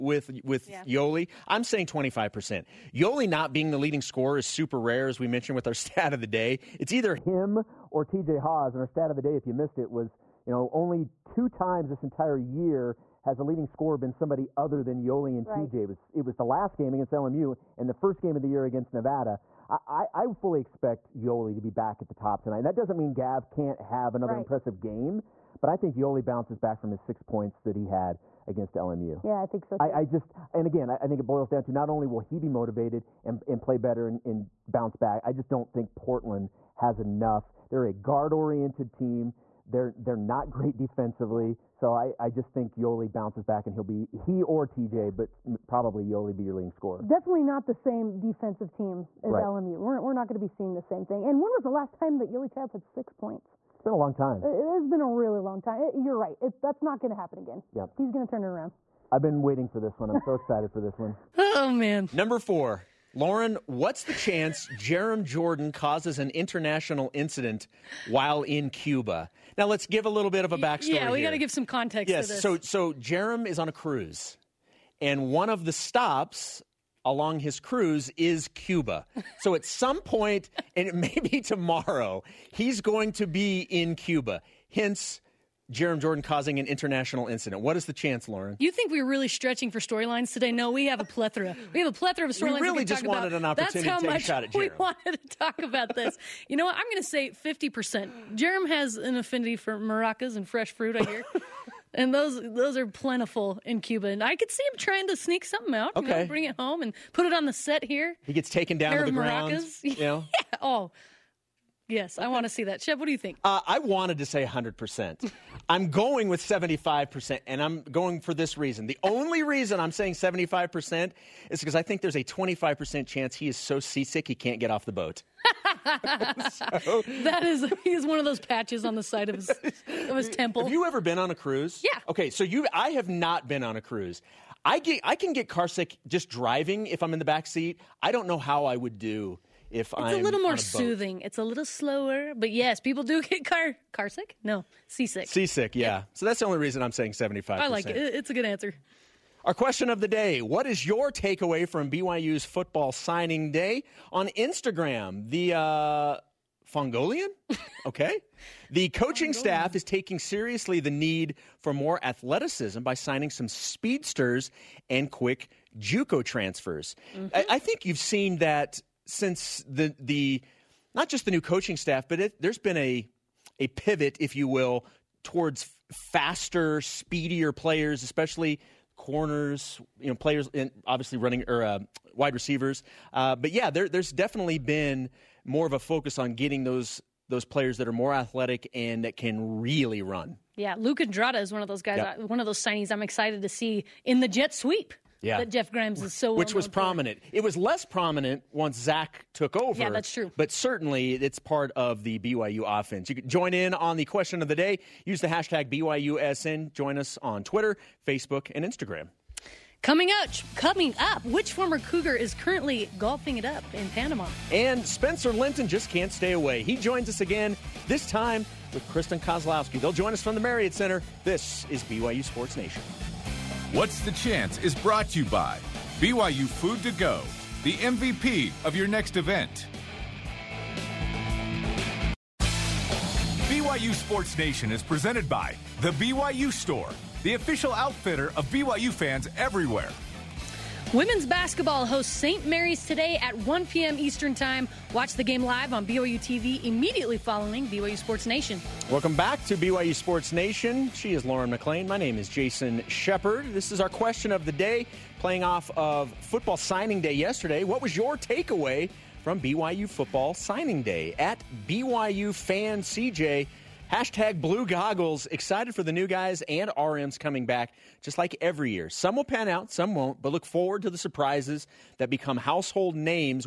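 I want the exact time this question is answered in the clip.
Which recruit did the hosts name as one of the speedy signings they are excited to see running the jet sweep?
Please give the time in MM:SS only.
03:10.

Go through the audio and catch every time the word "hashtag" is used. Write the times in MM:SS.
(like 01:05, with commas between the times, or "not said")
03:25, 04:23.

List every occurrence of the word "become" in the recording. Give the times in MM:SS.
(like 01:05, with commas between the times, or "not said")
04:32.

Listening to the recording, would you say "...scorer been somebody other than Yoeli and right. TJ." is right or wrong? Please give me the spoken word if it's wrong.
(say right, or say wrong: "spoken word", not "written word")
right.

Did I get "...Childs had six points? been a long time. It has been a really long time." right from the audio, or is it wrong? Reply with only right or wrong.
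right.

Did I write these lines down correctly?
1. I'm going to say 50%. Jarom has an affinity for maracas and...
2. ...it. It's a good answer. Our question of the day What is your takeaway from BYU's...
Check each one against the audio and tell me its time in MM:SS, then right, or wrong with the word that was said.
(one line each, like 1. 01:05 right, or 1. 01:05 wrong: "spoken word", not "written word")
1. 01:36 right
2. 02:27 right.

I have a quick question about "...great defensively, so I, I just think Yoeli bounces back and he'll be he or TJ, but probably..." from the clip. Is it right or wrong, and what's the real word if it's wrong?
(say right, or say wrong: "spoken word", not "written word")
right.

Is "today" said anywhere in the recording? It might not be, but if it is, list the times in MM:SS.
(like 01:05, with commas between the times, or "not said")
01:30, 04:02.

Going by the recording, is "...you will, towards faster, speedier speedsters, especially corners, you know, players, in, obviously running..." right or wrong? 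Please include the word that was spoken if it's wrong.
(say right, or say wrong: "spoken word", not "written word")
wrong: "players", not "speedsters".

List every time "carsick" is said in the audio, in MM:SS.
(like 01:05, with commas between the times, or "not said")
02:15, 02:23.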